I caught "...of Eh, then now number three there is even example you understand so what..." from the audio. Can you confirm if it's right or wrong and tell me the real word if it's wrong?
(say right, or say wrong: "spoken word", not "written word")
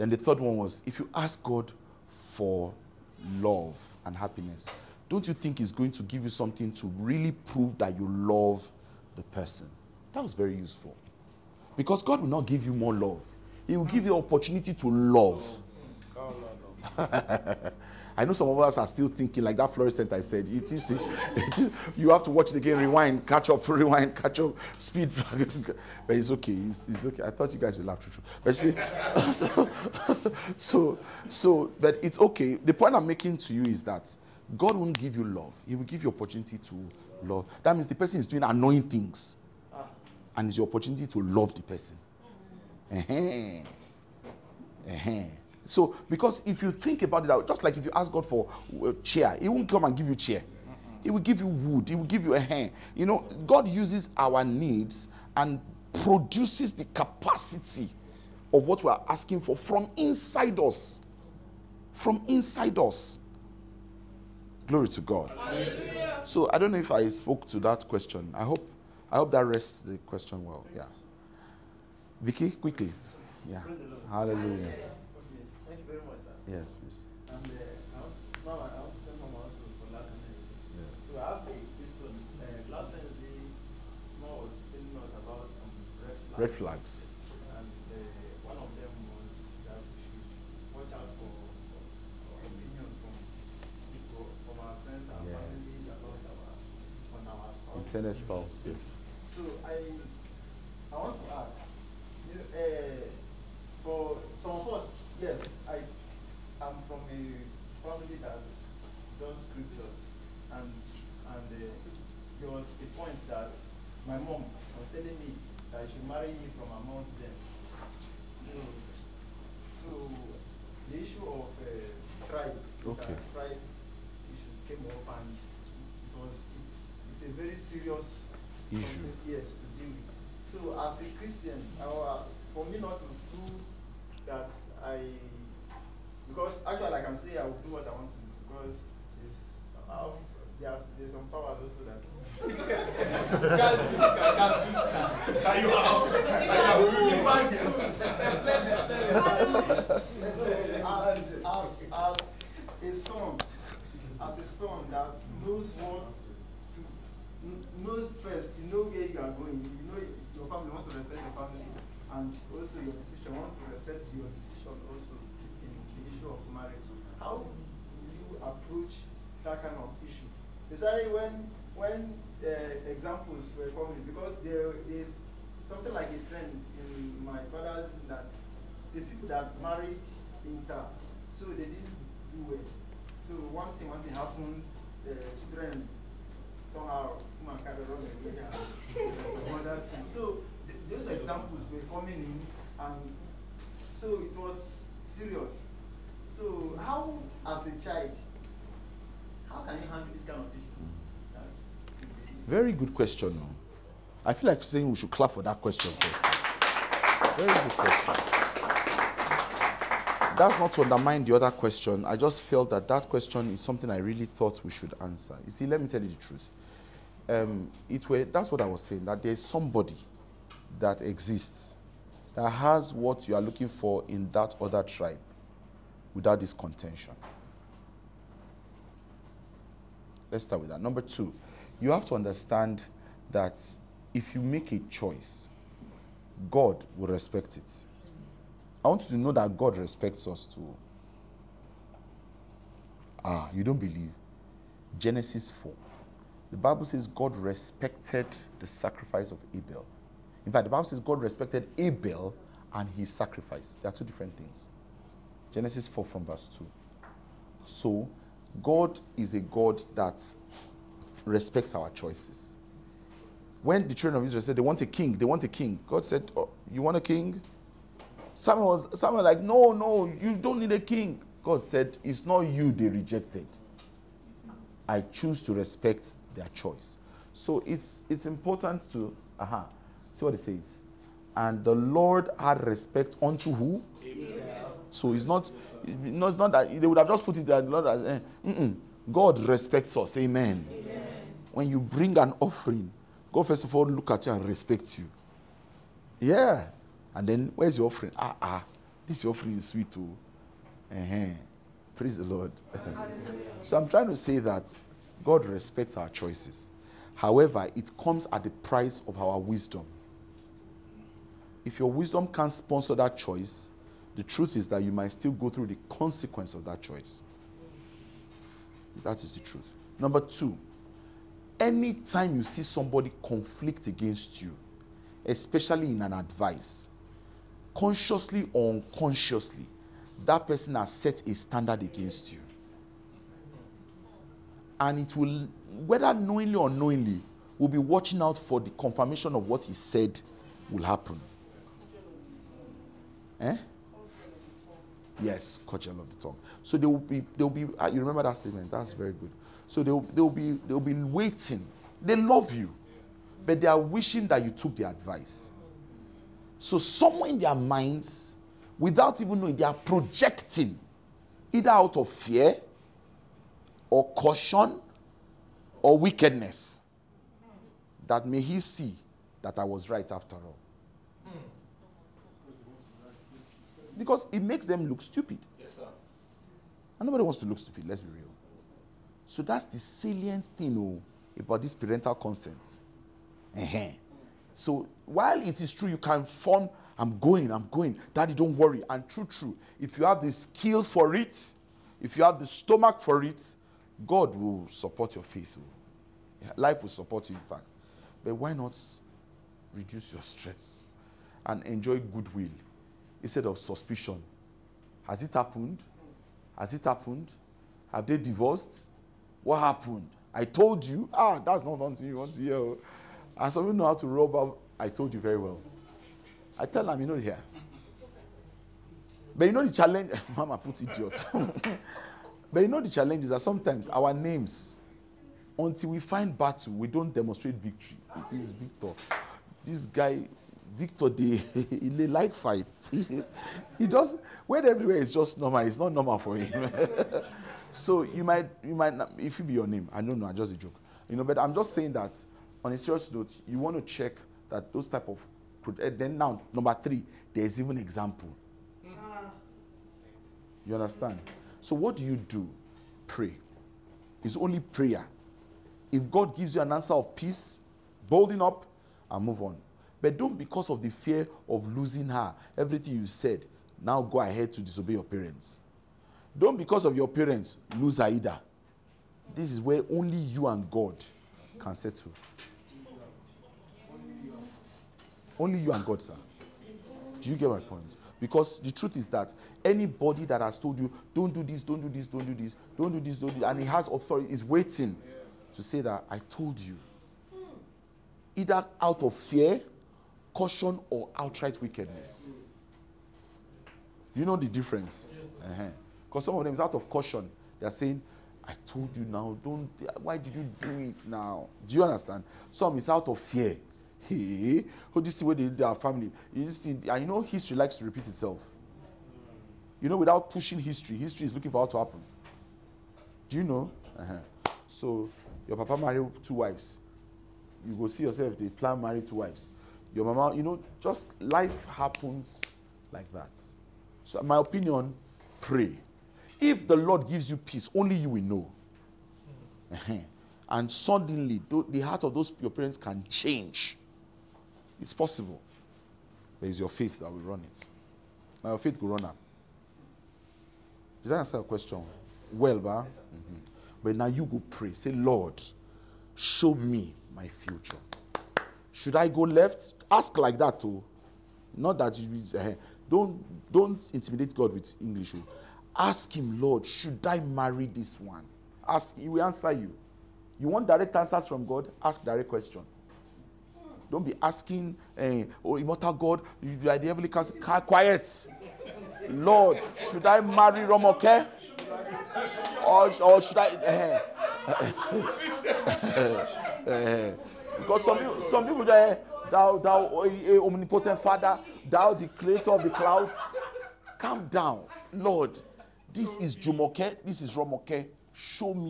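right.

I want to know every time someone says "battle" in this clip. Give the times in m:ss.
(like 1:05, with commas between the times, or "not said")
7:06.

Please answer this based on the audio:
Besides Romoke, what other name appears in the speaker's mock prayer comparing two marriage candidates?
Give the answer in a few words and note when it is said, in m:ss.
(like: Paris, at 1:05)
Jumoke, at 9:46.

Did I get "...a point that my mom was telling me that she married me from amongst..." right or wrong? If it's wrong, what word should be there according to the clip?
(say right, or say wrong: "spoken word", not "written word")
right.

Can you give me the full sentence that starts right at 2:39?
You know your family, you want to respect your family.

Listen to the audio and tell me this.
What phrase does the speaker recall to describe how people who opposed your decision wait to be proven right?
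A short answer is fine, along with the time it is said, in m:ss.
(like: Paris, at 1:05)
Cudgel of the tongue, at 5:45.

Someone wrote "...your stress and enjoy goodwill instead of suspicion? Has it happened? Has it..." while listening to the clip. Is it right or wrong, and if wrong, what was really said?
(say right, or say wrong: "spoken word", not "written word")
right.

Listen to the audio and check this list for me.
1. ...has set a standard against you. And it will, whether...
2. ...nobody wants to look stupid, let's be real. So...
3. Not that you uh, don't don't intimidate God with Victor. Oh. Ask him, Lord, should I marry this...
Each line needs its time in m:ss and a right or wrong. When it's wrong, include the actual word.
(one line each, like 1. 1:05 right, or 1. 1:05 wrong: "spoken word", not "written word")
1. 5:30 right
2. 6:17 right
3. 9:11 wrong: "English", not "Victor".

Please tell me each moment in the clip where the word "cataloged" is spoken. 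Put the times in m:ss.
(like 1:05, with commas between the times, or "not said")
not said.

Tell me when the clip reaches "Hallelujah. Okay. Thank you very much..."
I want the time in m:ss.
1:14.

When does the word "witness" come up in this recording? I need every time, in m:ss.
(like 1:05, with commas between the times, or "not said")
not said.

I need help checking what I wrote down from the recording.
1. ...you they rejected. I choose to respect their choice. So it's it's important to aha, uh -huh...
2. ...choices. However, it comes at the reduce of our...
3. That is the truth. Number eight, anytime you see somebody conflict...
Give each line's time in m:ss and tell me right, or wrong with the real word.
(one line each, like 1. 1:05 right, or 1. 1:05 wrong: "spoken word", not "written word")
1. 4:32 right
2. 5:06 wrong: "price", not "reduce"
3. 5:19 wrong: "two", not "eight".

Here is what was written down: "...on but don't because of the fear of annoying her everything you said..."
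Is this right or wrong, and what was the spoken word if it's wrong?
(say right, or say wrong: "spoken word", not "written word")
wrong: "losing", not "annoying".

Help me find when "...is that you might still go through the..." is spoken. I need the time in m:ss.
5:14.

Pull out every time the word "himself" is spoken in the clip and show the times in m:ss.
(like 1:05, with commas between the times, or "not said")
not said.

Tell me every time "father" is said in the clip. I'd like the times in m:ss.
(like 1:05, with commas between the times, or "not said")
2:57, 9:40.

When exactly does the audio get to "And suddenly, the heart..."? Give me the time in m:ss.
8:50.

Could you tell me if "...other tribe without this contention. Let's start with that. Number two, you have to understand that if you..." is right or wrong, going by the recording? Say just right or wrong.
right.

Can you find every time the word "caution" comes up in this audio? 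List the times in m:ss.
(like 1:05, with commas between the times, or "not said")
6:04, 8:10, 8:16.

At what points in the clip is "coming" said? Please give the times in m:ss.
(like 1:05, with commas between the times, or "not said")
2:53, 3:11.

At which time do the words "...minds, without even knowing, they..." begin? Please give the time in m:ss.
5:57.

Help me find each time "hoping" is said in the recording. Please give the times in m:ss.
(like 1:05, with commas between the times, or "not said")
not said.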